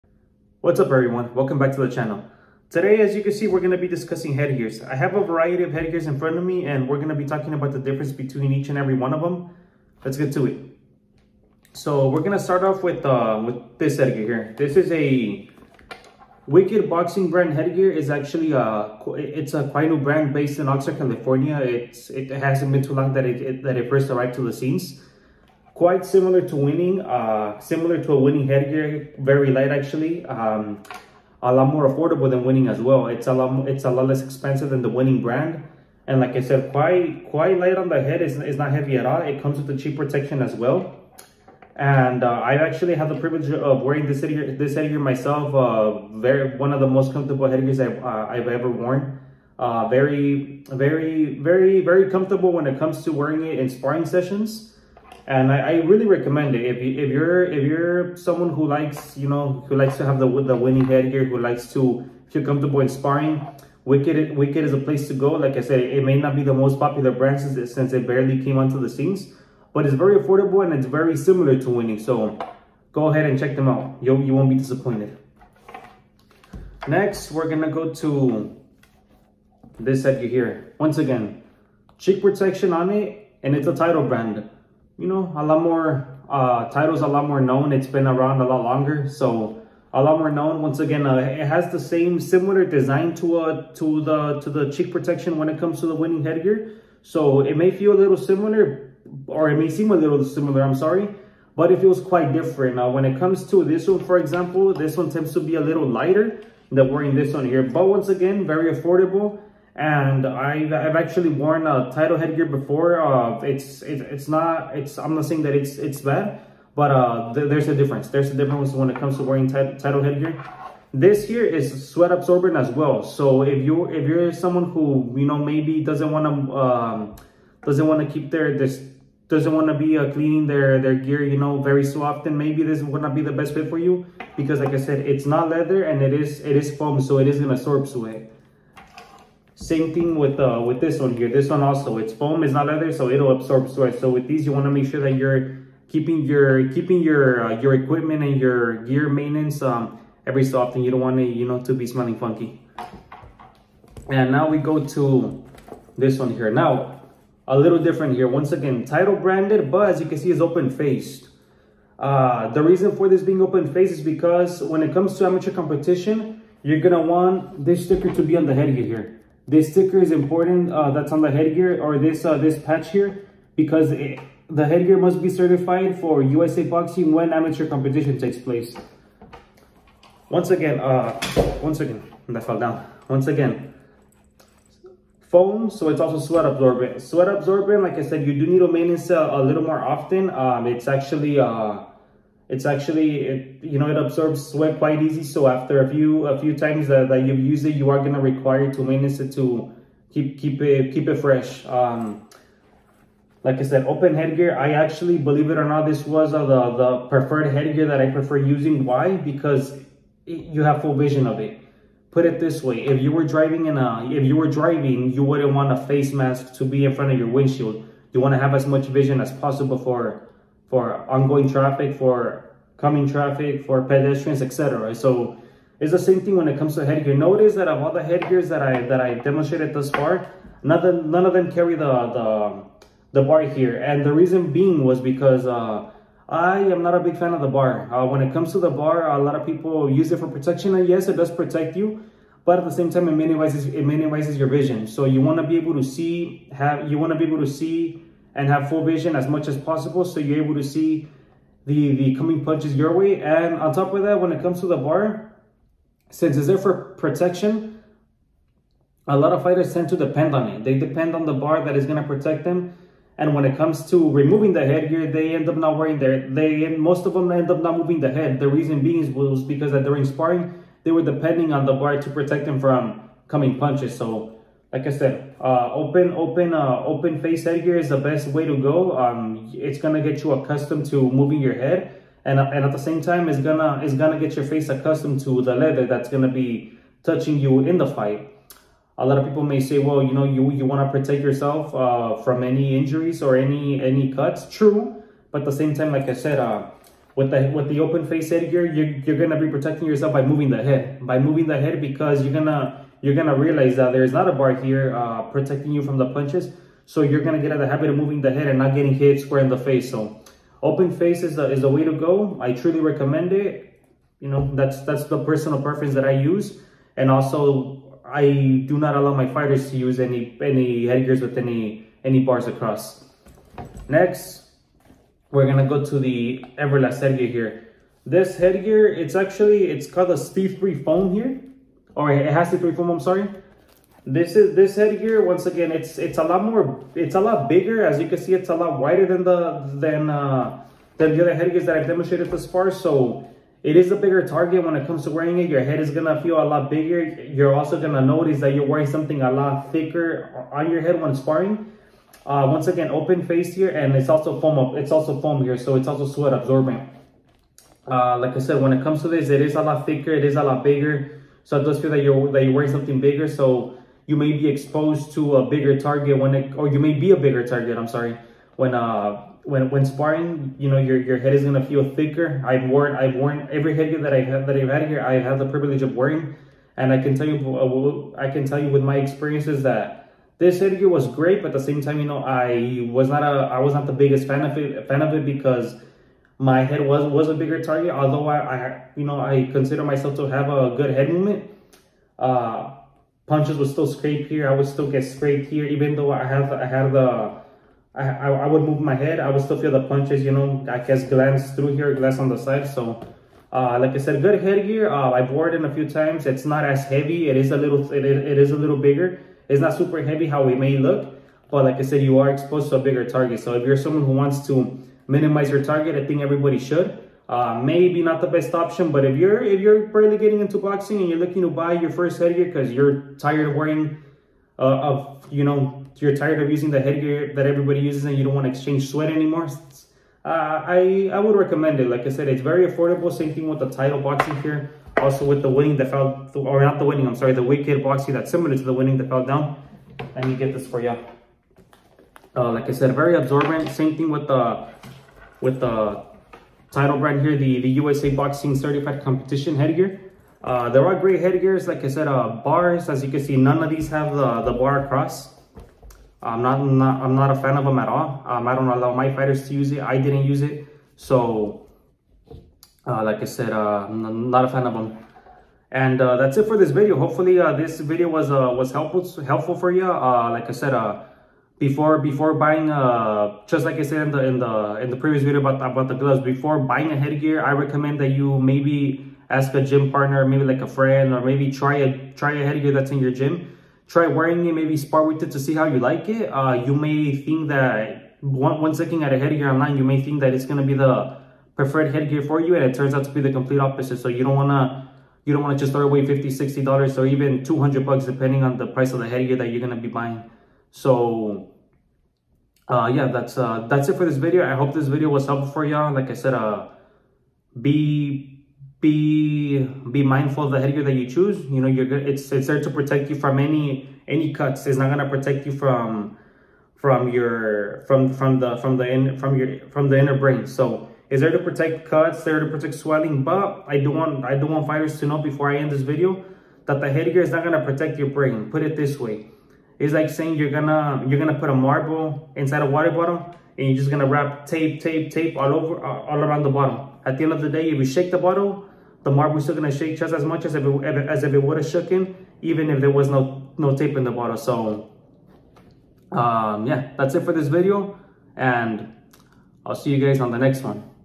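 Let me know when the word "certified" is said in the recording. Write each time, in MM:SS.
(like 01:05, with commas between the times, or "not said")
02:55, 07:28.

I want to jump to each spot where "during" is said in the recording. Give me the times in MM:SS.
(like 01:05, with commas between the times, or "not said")
04:29.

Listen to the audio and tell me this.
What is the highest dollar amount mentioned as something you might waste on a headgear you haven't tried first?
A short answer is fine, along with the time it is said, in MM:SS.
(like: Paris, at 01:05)
200, at 08:17.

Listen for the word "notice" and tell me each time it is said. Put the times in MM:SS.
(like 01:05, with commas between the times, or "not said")
03:47, 05:48.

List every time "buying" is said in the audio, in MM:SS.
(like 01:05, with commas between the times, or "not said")
07:52, 07:56, 08:20.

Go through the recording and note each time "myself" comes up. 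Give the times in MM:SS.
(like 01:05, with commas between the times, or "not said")
00:44, 06:29.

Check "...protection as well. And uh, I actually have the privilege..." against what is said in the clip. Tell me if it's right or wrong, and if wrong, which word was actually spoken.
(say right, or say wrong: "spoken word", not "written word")
right.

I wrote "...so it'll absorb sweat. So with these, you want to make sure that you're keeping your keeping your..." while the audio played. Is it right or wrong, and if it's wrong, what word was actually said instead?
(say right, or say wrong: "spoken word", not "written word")
right.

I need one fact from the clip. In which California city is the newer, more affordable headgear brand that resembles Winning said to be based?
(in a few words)
Oxnard.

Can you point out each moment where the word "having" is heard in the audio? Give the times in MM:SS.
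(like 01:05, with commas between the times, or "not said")
not said.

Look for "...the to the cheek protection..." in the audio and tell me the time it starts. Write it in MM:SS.
01:34.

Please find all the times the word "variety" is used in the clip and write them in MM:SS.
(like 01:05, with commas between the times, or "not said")
00:05.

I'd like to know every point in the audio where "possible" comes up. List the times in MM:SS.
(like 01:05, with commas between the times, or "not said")
03:39, 04:09.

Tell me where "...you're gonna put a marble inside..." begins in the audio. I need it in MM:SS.
08:51.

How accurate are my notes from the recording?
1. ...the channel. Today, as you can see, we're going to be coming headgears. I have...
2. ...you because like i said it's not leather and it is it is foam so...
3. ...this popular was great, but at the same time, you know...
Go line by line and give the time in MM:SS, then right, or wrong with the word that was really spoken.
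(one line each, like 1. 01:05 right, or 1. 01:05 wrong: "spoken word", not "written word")
1. 00:01 wrong: "discussing", not "coming"
2. 02:13 right
3. 06:20 wrong: "headgear", not "popular".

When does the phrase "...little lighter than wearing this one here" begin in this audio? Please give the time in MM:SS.
01:45.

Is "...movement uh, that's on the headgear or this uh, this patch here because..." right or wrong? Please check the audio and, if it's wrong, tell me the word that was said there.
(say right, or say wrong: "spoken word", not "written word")
wrong: "important", not "movement".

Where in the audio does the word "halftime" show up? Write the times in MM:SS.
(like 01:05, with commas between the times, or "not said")
not said.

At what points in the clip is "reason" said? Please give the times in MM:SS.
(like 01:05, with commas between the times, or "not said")
02:42, 03:54, 04:28.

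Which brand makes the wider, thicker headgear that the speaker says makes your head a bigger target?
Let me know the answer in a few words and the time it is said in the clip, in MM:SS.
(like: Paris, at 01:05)
Everlast, at 05:26.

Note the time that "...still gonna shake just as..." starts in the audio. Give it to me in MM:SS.
08:59.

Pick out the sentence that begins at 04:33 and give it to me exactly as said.
So like I said, uh, open open uh, open face headgear is the best way to go.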